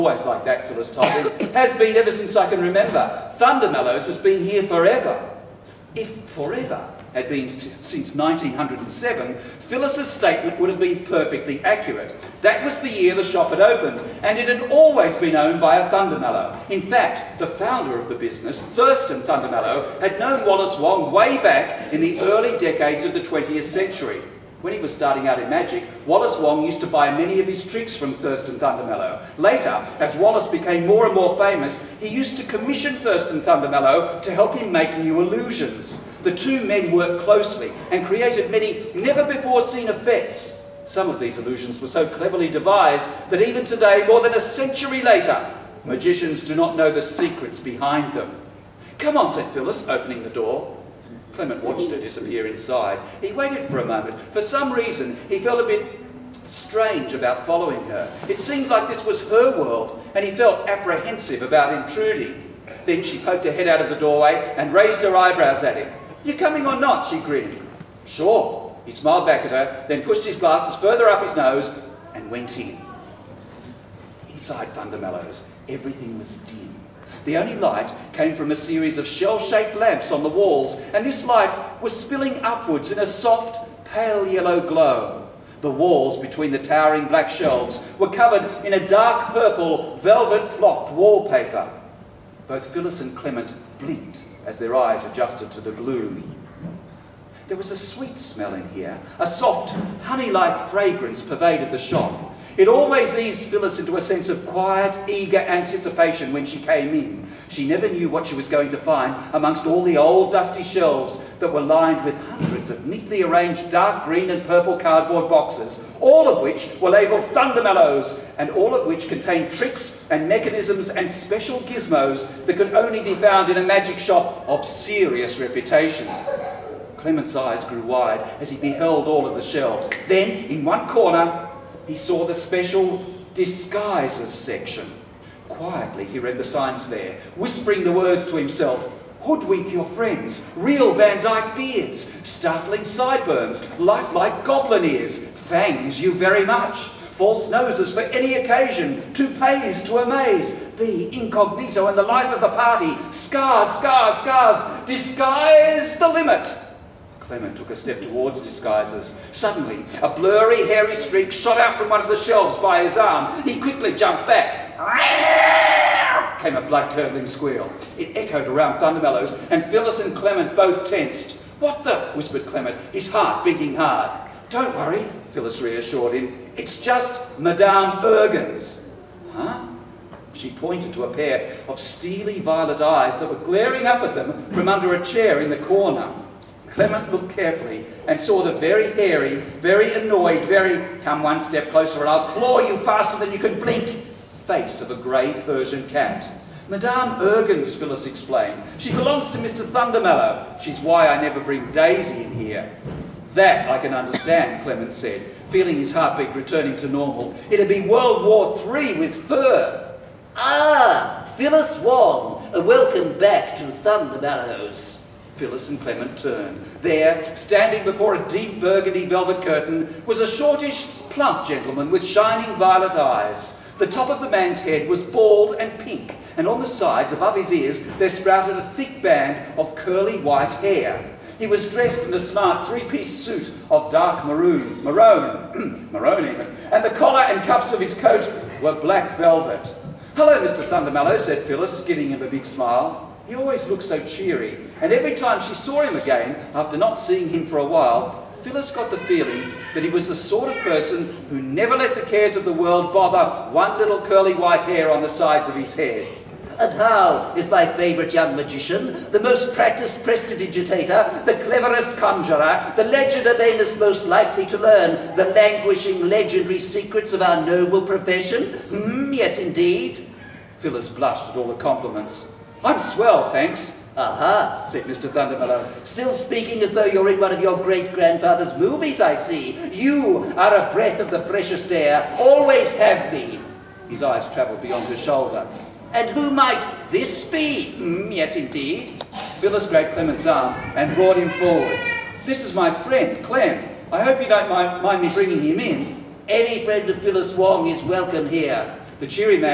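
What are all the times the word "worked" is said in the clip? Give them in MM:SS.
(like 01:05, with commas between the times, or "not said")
00:36.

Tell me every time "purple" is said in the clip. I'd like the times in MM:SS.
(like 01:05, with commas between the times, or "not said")
01:29, 01:54.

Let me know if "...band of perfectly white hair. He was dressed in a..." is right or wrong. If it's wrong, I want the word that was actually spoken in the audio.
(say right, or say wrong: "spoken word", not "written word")
wrong: "curly", not "perfectly".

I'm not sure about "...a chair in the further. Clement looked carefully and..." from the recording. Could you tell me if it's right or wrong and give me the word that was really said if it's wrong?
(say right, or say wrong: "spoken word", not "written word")
wrong: "corner", not "further".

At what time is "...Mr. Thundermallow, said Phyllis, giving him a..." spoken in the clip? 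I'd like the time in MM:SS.
04:00.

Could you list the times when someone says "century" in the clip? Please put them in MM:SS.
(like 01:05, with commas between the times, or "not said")
00:23, 00:44.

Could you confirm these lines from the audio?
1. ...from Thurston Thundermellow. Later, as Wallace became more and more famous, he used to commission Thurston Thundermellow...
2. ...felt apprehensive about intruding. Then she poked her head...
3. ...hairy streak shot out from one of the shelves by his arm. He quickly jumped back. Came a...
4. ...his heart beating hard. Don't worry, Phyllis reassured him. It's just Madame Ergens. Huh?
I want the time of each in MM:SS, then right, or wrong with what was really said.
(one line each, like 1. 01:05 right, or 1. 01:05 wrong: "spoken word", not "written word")
1. 00:27 right
2. 01:00 right
3. 02:40 right
4. 02:52 right.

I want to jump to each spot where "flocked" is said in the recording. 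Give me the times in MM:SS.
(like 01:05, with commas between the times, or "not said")
01:30.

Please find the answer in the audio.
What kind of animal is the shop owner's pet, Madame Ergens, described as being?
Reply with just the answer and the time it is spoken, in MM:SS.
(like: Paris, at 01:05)
Grey Persian cat, at 03:14.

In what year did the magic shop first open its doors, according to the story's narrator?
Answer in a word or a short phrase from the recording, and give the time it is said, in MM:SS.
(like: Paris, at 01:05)
1907, at 00:08.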